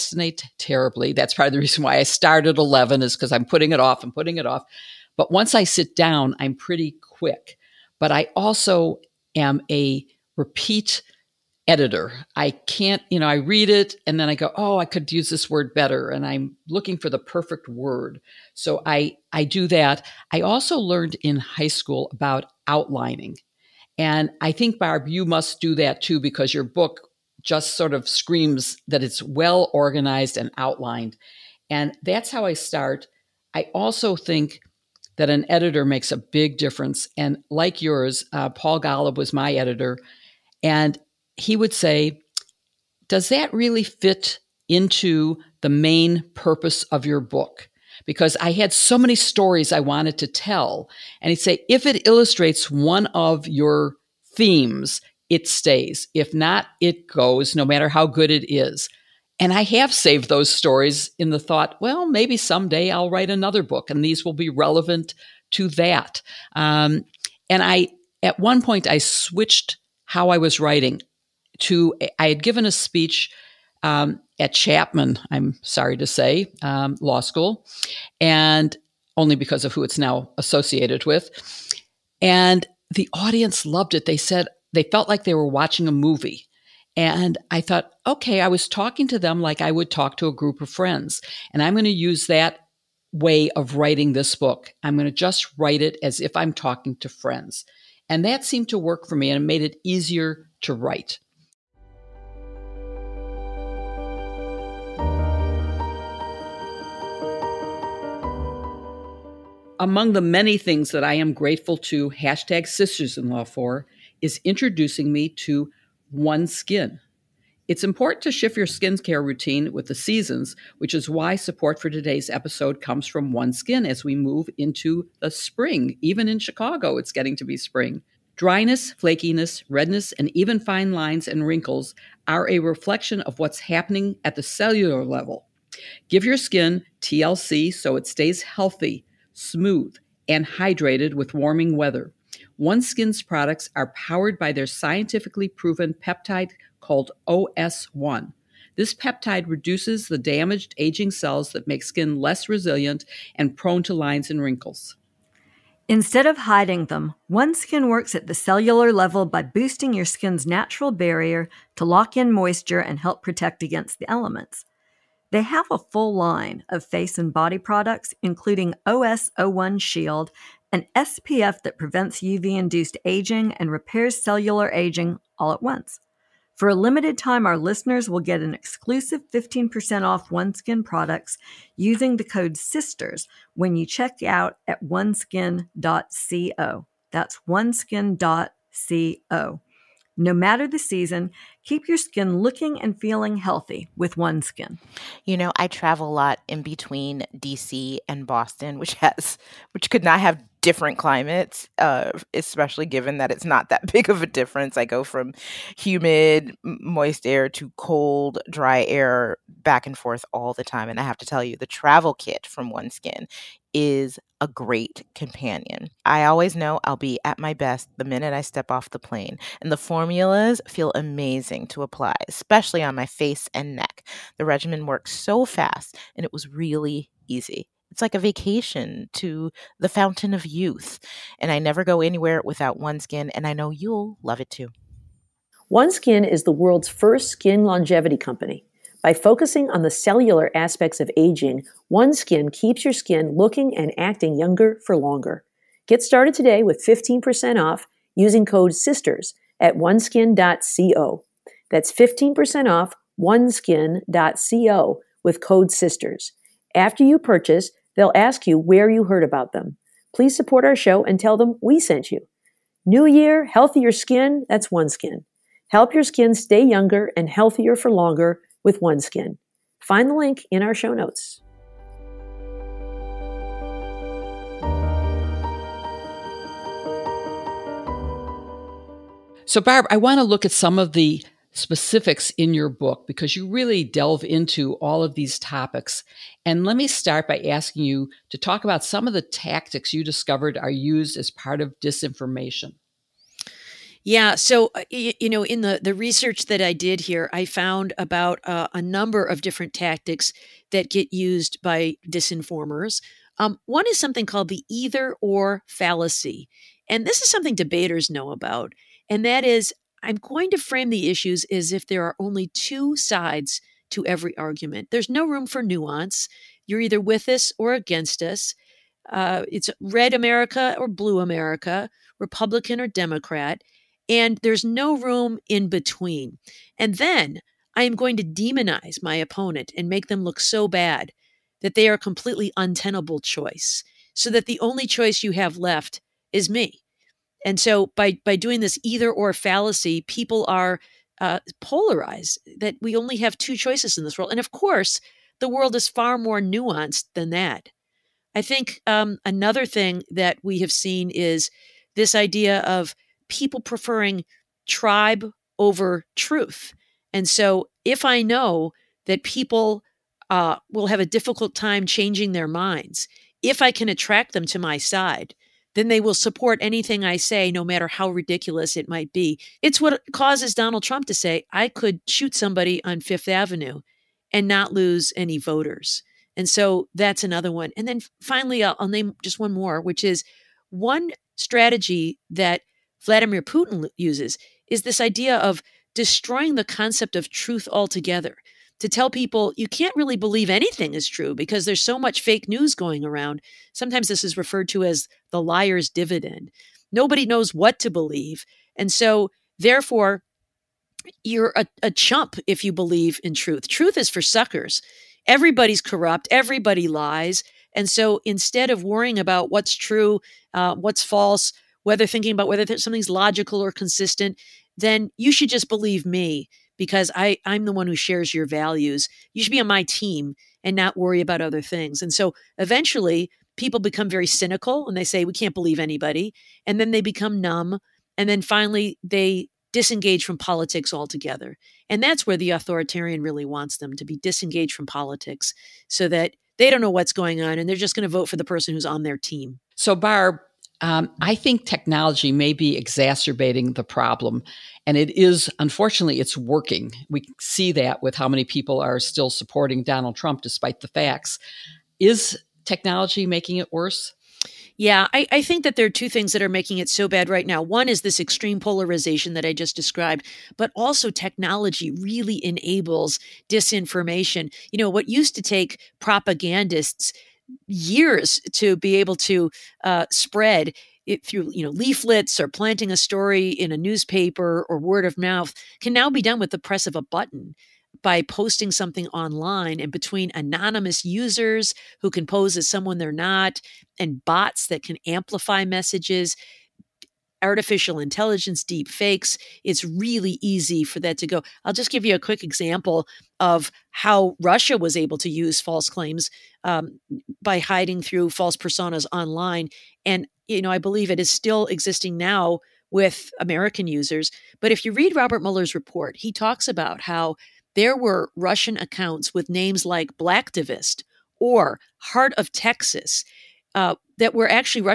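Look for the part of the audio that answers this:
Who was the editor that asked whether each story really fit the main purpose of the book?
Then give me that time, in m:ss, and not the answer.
0:38.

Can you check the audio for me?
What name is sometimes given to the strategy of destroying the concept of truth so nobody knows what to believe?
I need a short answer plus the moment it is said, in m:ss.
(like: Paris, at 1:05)
liar's dividend, at 6:35.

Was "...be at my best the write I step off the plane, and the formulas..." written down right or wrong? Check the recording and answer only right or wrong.
wrong.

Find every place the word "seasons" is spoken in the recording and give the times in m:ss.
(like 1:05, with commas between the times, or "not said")
1:59, 3:10.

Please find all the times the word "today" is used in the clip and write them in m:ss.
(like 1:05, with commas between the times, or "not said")
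2:01, 4:06.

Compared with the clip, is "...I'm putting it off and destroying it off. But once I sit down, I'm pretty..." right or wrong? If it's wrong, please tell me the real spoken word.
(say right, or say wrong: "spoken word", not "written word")
wrong: "putting", not "destroying".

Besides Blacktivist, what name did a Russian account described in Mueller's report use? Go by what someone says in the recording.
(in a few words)
Heart of Texas.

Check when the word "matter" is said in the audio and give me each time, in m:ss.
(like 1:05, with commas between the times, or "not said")
0:57, 3:10, 6:07.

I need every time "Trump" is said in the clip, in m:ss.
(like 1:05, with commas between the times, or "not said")
6:10, 7:30.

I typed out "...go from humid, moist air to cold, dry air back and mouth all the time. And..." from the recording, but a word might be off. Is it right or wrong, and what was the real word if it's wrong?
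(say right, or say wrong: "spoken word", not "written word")
wrong: "forth", not "mouth".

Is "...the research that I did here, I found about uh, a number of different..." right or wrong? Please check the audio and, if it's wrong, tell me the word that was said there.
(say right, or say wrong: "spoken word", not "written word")
right.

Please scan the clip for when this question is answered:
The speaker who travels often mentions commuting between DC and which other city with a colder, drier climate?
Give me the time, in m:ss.
3:18.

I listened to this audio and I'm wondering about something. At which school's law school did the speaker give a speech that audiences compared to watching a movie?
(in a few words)
Chapman.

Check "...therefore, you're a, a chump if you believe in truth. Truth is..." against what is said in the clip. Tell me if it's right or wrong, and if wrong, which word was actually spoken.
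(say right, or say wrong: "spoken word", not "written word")
right.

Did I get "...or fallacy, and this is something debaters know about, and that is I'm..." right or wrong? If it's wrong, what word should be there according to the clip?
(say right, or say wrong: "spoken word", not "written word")
right.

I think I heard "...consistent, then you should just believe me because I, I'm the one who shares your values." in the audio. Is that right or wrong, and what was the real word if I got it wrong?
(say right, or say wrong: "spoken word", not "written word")
right.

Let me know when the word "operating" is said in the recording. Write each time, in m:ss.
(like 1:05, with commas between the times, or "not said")
not said.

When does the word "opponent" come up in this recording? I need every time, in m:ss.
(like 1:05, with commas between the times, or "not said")
5:29.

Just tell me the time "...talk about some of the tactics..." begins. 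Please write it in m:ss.
4:48.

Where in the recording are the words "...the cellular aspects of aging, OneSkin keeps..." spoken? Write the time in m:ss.
3:59.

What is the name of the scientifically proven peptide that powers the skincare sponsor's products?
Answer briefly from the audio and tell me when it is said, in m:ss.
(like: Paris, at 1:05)
OS1, at 2:27.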